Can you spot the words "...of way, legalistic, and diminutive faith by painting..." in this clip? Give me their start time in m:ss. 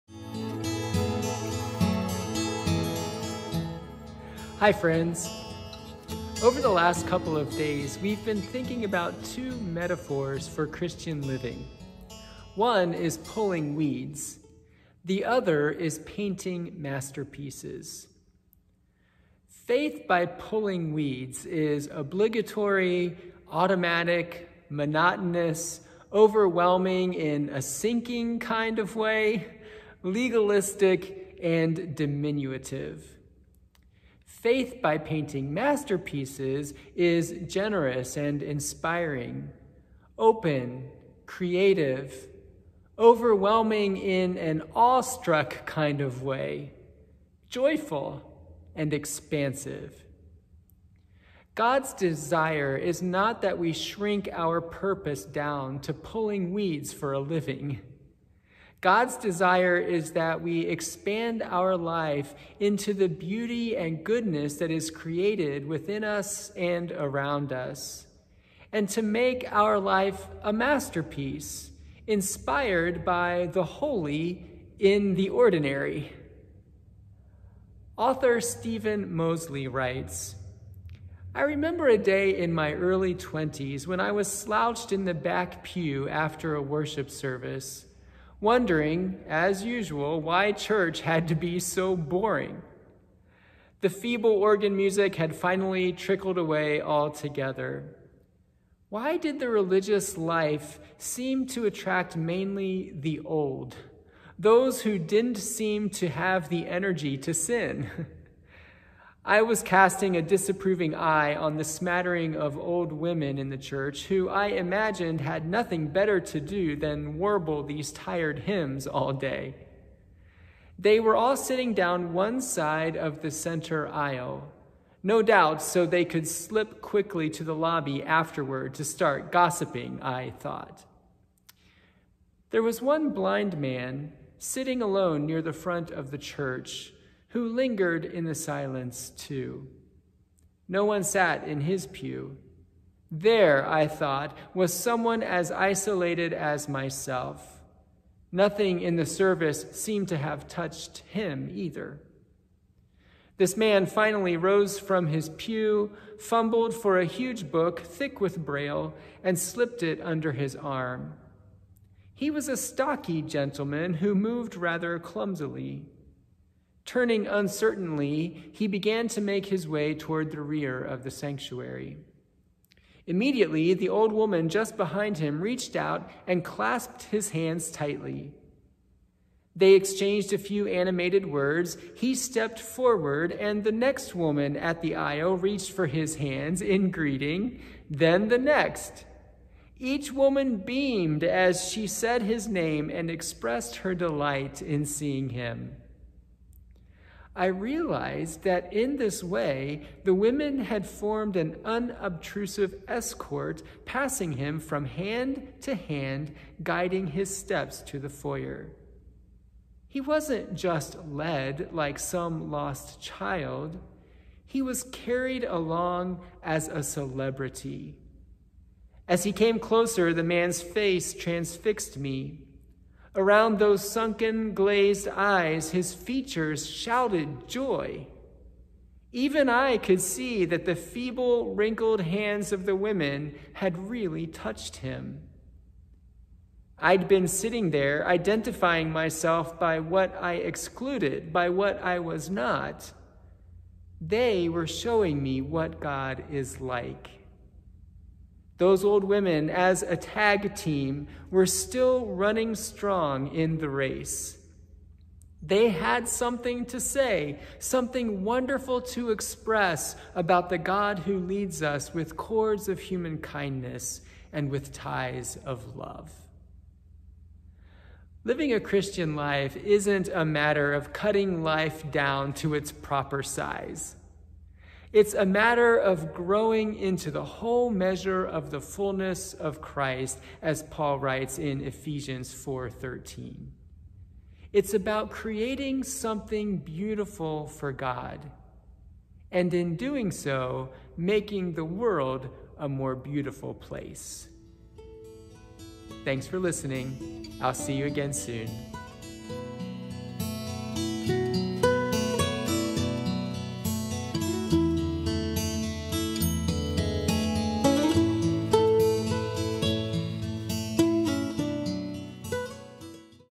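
0:28.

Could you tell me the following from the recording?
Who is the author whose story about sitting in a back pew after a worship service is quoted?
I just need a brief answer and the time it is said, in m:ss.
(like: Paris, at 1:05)
Steven Mosley, at 1:18.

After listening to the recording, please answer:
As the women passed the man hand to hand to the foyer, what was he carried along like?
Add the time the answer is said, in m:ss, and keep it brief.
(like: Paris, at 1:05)
A celebrity, at 3:36.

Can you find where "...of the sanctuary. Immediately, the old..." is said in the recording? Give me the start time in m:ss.
2:50.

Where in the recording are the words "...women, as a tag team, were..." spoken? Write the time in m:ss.
4:09.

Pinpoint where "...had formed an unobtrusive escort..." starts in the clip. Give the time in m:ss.
3:20.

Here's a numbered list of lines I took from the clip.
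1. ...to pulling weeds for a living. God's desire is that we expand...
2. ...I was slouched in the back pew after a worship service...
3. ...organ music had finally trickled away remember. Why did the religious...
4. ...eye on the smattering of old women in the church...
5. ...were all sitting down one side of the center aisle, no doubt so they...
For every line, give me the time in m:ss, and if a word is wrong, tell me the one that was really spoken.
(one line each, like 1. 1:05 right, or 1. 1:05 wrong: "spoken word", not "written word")
1. 0:55 right
2. 1:23 right
3. 1:34 wrong: "altogether", not "remember"
4. 1:50 right
5. 2:00 right.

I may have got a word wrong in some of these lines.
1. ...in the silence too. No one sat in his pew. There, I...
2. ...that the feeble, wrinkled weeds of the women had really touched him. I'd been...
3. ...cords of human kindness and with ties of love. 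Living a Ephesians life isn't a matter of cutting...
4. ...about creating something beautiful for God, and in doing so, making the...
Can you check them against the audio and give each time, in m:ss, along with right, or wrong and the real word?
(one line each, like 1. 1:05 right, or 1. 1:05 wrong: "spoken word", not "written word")
1. 2:18 right
2. 3:50 wrong: "hands", not "weeds"
3. 4:22 wrong: "Christian", not "Ephesians"
4. 4:44 right.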